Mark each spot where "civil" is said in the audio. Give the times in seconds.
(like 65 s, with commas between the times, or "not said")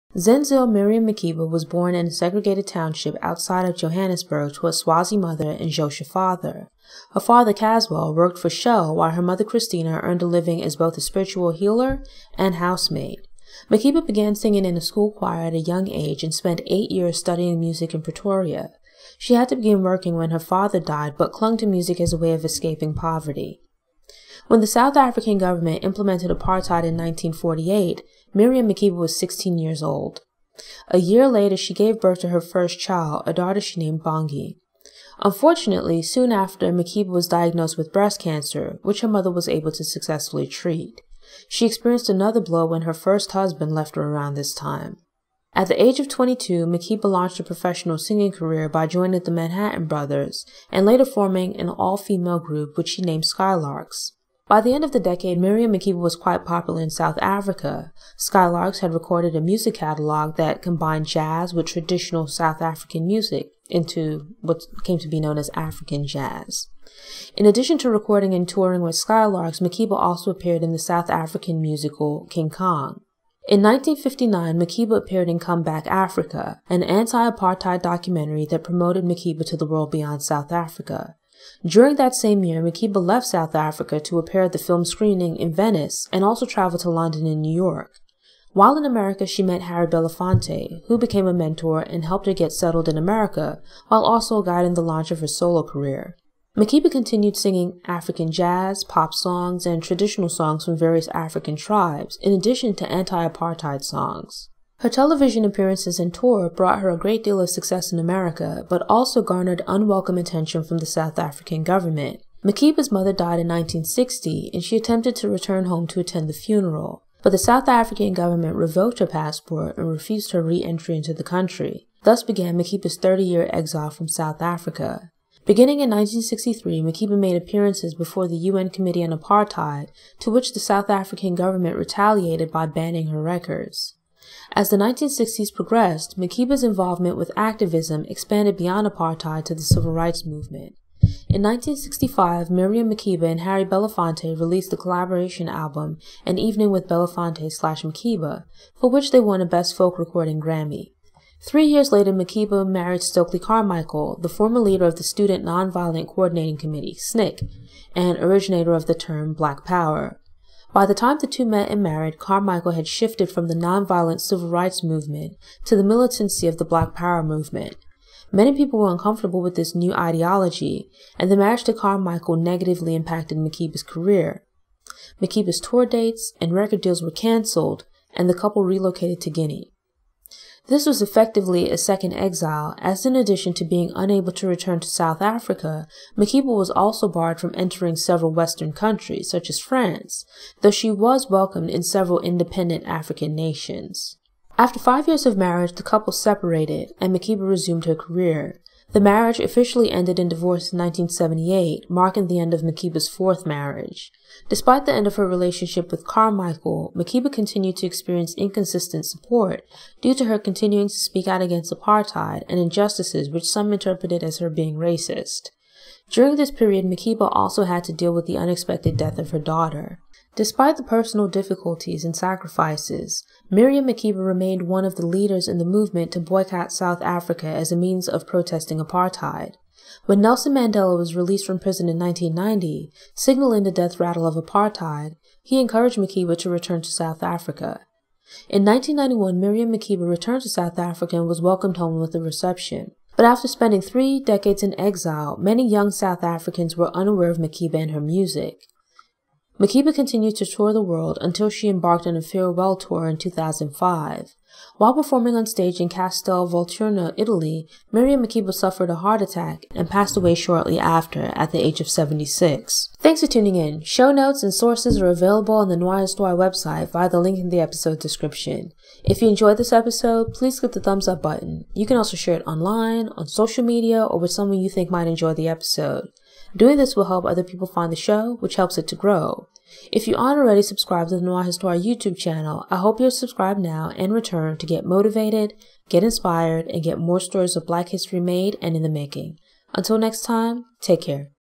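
139 s, 164 s.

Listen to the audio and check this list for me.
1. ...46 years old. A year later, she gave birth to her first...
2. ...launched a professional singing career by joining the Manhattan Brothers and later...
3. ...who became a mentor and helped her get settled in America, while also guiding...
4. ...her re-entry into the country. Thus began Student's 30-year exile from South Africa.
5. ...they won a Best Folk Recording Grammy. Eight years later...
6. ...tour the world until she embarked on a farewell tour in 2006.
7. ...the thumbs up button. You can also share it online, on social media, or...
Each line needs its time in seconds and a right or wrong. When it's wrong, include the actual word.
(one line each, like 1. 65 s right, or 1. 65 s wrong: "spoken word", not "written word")
1. 29 s wrong: "16", not "46"
2. 47 s right
3. 90 s right
4. 120 s wrong: "Makeba", not "Student"
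5. 149 s wrong: "Three", not "Eight"
6. 250 s wrong: "2005", not "2006"
7. 270 s right.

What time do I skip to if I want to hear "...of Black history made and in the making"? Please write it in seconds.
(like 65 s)
287 s.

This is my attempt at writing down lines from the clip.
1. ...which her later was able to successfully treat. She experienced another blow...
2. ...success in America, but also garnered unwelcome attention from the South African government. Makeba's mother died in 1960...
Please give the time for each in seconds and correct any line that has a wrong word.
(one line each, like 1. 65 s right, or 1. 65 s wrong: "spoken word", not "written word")
1. 38 s wrong: "mother", not "later"
2. 107 s right.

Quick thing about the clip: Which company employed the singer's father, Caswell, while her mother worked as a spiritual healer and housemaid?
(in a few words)
Shell.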